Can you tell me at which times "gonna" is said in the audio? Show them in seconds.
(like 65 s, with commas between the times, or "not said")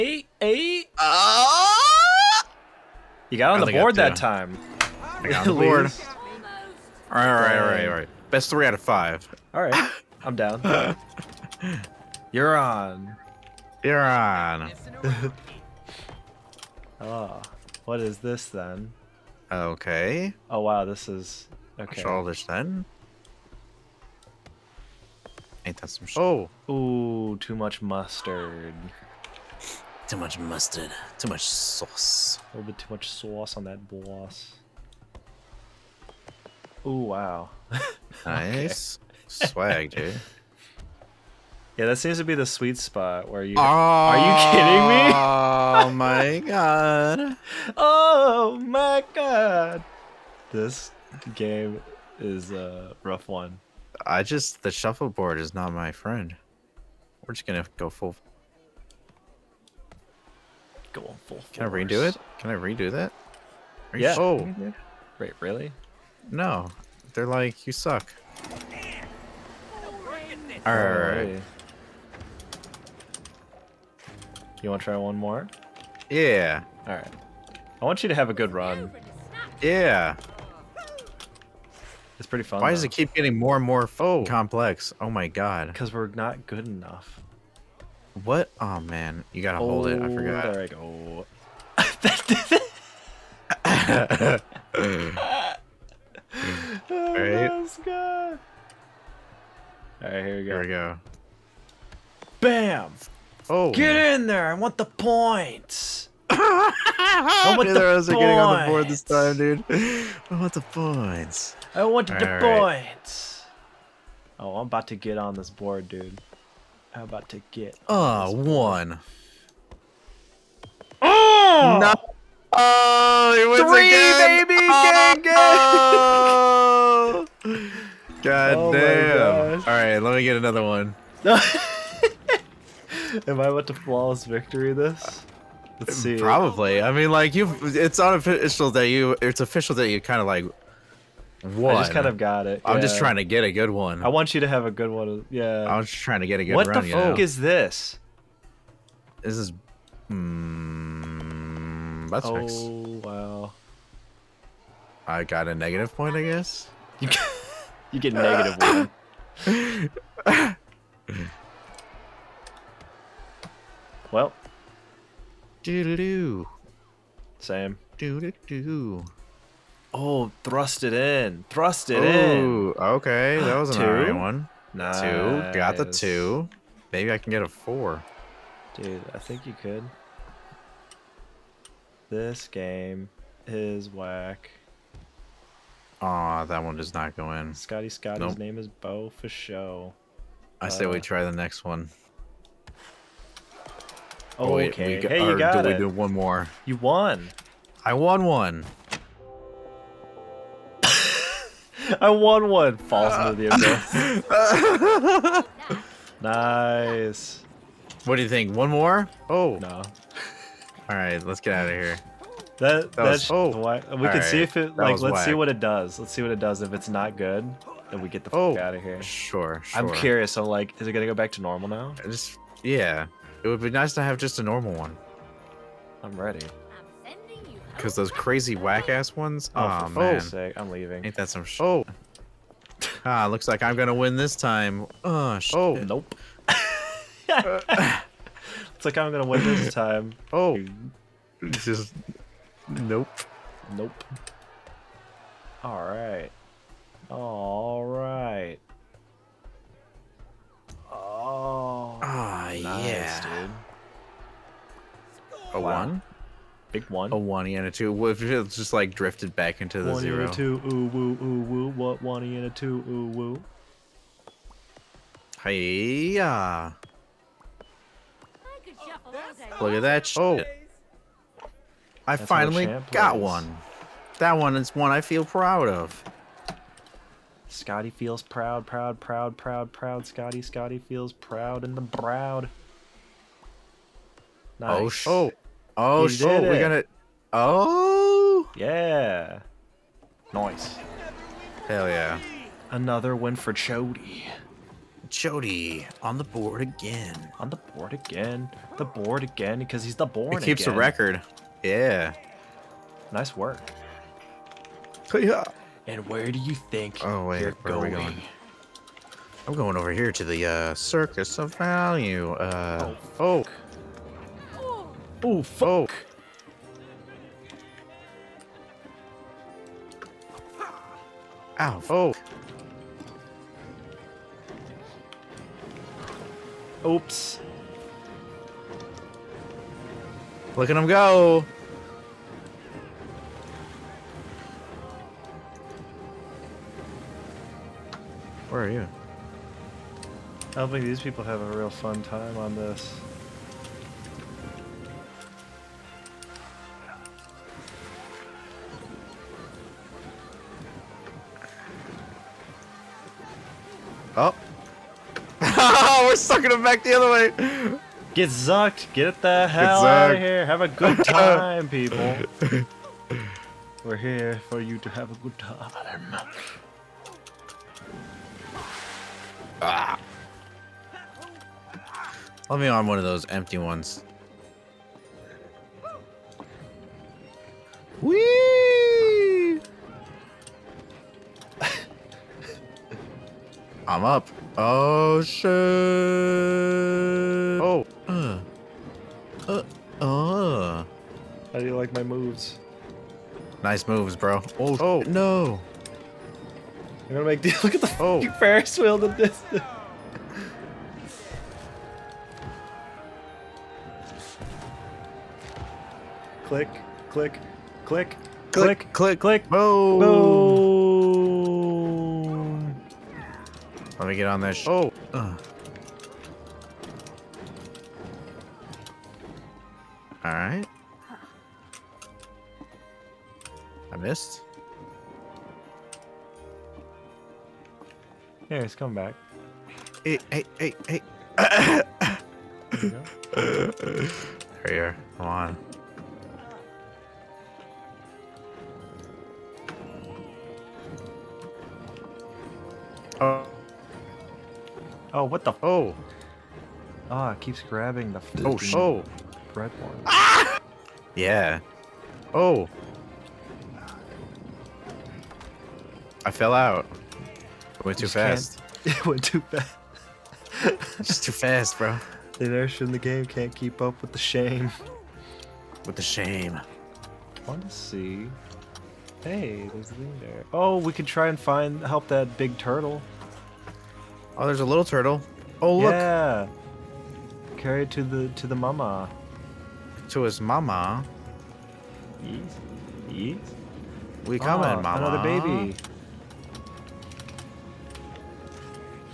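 57 s, 233 s, 239 s, 286 s, 397 s.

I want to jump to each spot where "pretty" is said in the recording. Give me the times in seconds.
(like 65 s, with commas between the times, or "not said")
82 s.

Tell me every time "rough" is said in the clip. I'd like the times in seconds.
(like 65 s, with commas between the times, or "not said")
53 s.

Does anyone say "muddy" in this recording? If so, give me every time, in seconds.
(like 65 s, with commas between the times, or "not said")
not said.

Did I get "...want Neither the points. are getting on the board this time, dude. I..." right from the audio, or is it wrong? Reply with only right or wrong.
right.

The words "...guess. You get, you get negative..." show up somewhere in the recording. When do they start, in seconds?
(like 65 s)
156 s.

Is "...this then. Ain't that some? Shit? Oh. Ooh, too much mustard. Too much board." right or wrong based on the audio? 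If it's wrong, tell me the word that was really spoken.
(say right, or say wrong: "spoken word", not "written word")
wrong: "mustard", not "board".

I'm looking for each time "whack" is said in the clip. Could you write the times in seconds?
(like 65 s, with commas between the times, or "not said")
183 s, 215 s, 228 s.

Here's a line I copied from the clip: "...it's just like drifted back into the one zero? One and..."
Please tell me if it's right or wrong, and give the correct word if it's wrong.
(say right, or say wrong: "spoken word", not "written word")
right.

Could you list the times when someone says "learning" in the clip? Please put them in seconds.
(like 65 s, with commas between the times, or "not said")
not said.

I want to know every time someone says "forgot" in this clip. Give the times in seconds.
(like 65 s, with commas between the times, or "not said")
90 s.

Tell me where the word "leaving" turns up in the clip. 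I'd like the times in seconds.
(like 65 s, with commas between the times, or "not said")
230 s.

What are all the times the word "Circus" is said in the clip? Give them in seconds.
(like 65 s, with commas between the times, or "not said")
310 s.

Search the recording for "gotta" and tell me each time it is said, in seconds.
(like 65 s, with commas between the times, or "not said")
89 s.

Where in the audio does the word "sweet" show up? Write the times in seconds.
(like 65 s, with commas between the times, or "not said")
42 s.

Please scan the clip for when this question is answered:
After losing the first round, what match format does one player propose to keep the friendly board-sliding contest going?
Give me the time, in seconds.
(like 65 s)
8 s.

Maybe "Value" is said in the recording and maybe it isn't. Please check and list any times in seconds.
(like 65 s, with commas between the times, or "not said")
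311 s.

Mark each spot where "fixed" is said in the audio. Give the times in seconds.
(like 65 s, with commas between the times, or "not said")
152 s.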